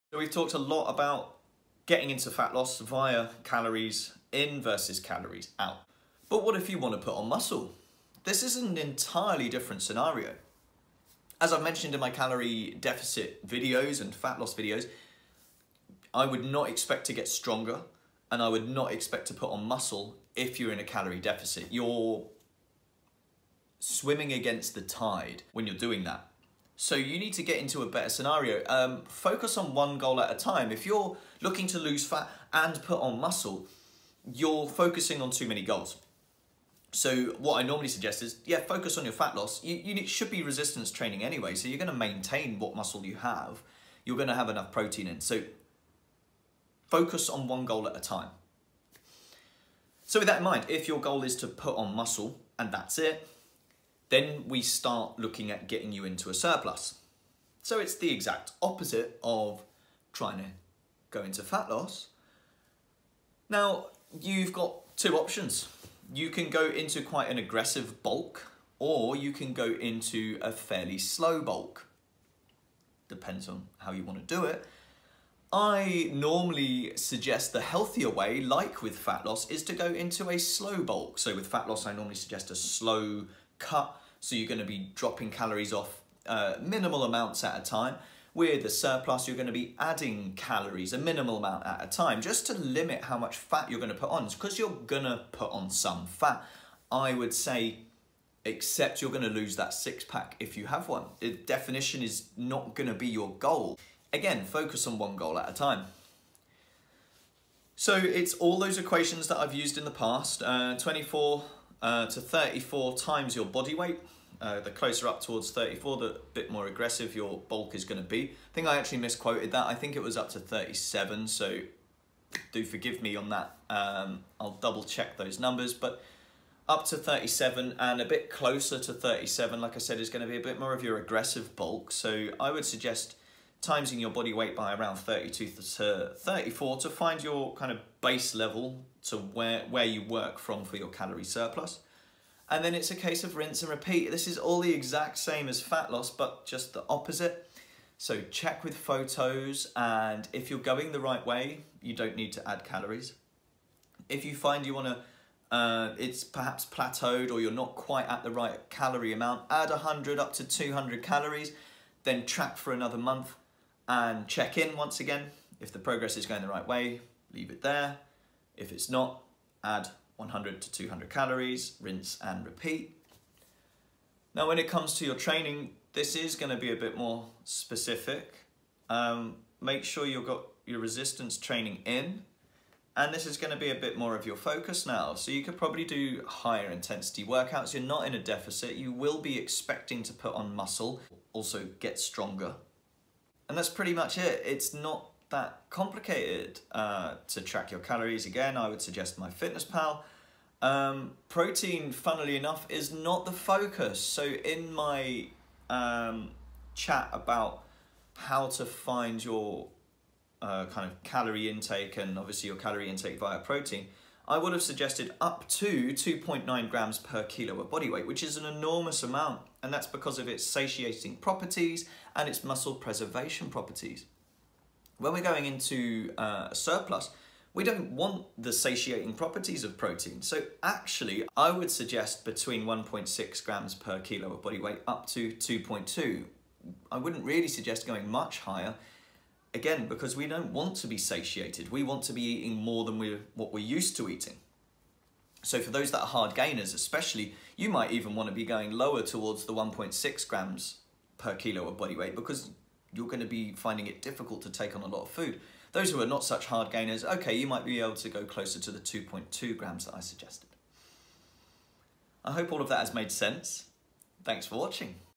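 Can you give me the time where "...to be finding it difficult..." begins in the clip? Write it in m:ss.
4:13.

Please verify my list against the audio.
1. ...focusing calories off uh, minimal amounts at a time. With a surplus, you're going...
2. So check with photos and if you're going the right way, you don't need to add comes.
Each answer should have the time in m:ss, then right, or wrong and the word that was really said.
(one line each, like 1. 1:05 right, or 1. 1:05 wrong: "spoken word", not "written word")
1. 1:24 wrong: "dropping", not "focusing"
2. 2:27 wrong: "calories", not "comes".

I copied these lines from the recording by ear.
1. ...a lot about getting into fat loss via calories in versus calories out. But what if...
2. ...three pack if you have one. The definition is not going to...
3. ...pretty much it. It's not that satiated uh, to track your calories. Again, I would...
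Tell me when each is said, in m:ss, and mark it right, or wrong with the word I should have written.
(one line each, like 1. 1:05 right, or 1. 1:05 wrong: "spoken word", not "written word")
1. 0:00 right
2. 1:39 wrong: "six", not "three"
3. 3:13 wrong: "complicated", not "satiated".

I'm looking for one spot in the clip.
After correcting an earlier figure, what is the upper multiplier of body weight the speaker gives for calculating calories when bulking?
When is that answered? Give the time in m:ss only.
1:59.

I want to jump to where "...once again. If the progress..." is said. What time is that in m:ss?
2:44.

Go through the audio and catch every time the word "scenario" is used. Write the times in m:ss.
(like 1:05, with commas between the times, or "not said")
0:09, 0:28.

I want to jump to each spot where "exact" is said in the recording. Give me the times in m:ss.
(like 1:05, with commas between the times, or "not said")
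0:58, 2:24.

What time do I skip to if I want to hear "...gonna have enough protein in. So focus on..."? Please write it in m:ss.
0:44.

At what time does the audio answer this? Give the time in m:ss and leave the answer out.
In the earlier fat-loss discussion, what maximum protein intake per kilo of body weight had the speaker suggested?
3:35.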